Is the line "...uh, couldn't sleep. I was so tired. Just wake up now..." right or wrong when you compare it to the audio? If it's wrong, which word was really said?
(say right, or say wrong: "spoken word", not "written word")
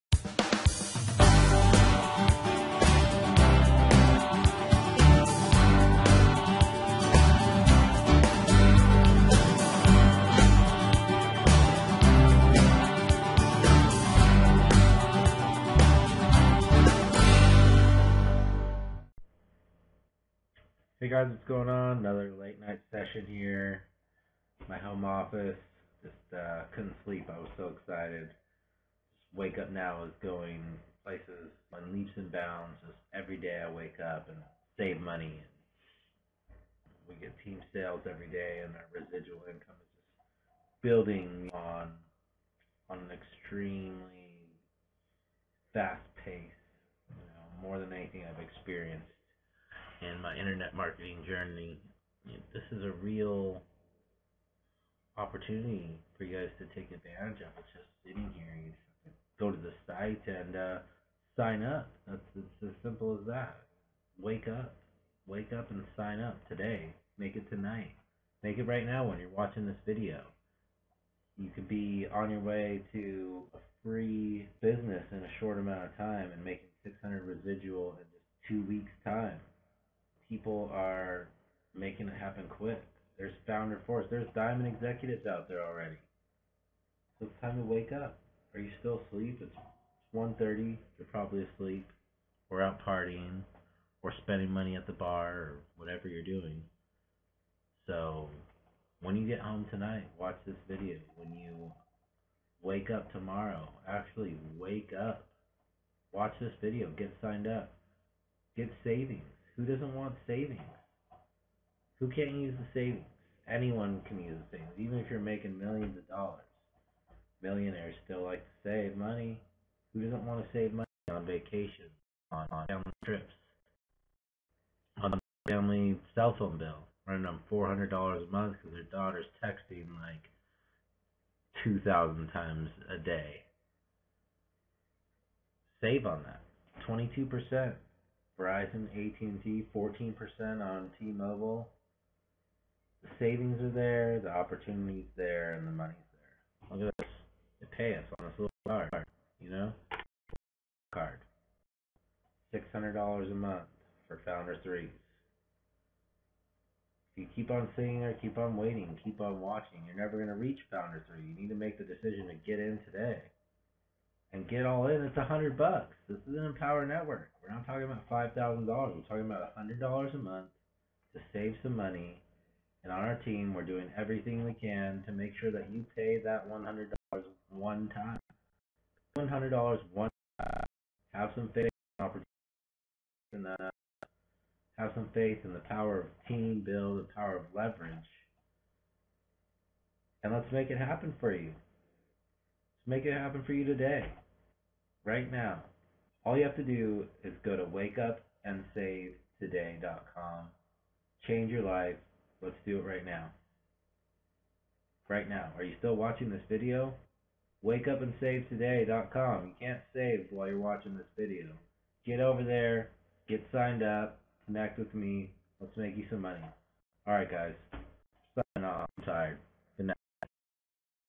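wrong: "excited", not "tired".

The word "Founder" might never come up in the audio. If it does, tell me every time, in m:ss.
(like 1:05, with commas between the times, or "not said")
1:23, 2:34, 2:40.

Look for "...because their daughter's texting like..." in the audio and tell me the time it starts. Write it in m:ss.
2:08.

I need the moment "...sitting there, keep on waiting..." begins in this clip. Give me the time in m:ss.
2:37.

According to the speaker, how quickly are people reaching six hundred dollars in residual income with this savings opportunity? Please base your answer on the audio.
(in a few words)
2 weeks.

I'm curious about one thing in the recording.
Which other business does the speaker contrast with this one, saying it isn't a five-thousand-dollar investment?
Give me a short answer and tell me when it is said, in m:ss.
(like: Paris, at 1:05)
Empower Network, at 2:46.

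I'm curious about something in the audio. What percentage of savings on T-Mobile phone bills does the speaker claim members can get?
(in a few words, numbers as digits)
14%.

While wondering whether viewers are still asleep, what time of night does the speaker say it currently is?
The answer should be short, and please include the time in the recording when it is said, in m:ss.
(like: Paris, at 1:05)
1:30, at 1:30.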